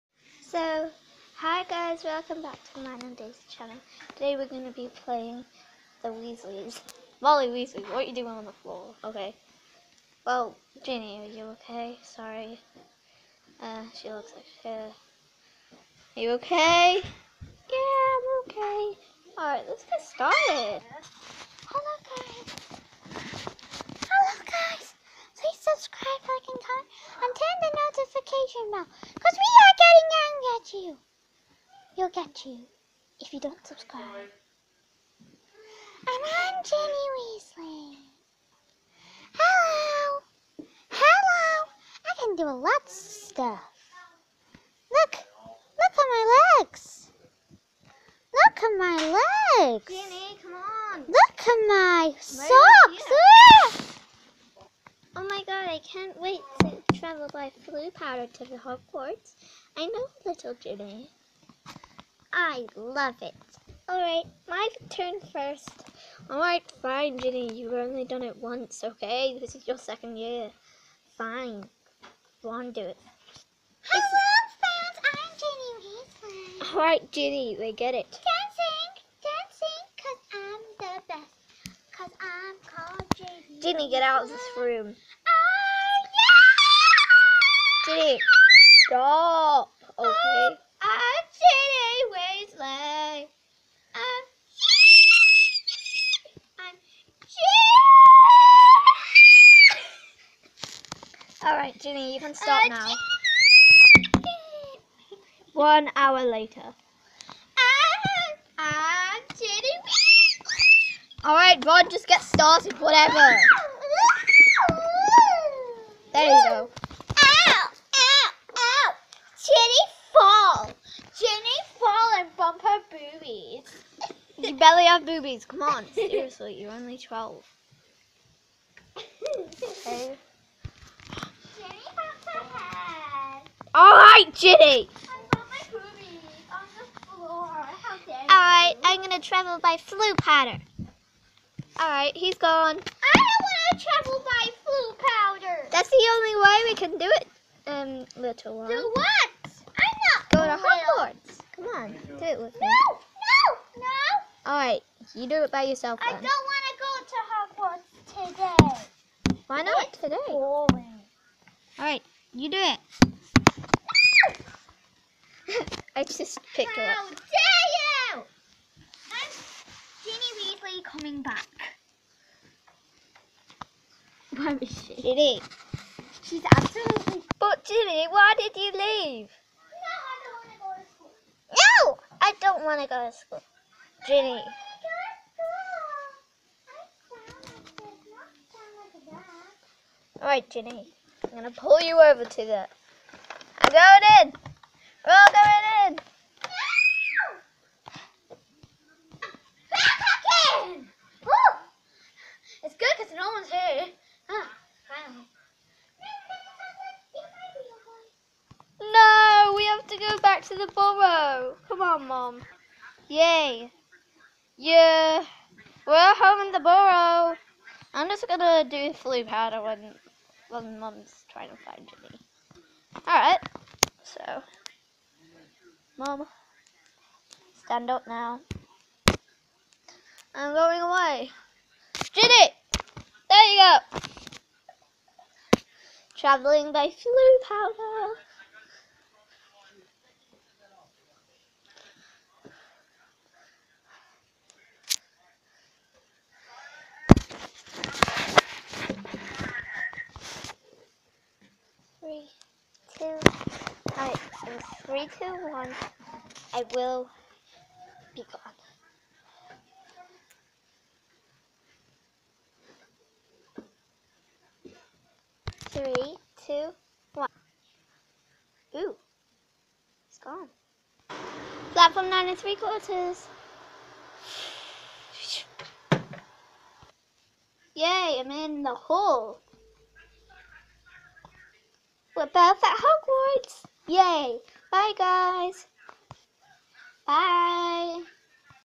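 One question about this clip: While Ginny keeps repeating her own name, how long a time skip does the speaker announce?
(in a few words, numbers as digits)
One hour.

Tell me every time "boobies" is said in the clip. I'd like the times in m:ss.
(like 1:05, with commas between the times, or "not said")
2:05, 2:15.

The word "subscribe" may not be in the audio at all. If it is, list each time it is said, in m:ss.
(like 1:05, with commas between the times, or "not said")
0:25, 0:33.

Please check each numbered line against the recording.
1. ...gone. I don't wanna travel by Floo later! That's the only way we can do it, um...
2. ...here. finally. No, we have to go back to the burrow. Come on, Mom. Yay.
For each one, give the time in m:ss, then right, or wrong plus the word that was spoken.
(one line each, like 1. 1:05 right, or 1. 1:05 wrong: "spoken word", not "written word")
1. 2:22 wrong: "powder", not "later"
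2. 3:23 right.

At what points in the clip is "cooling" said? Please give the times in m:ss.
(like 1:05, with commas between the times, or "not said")
not said.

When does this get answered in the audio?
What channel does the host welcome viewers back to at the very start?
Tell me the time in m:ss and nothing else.
0:02.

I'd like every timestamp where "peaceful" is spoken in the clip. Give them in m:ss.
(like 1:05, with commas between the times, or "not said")
not said.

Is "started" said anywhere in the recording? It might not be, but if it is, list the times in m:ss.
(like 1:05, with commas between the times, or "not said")
0:20, 1:52.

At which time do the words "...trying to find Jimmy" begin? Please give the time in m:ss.
3:41.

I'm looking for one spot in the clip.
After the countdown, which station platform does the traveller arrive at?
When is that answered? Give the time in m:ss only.
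4:31.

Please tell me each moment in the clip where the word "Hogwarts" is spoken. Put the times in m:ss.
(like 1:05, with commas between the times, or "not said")
0:58, 2:30, 2:38.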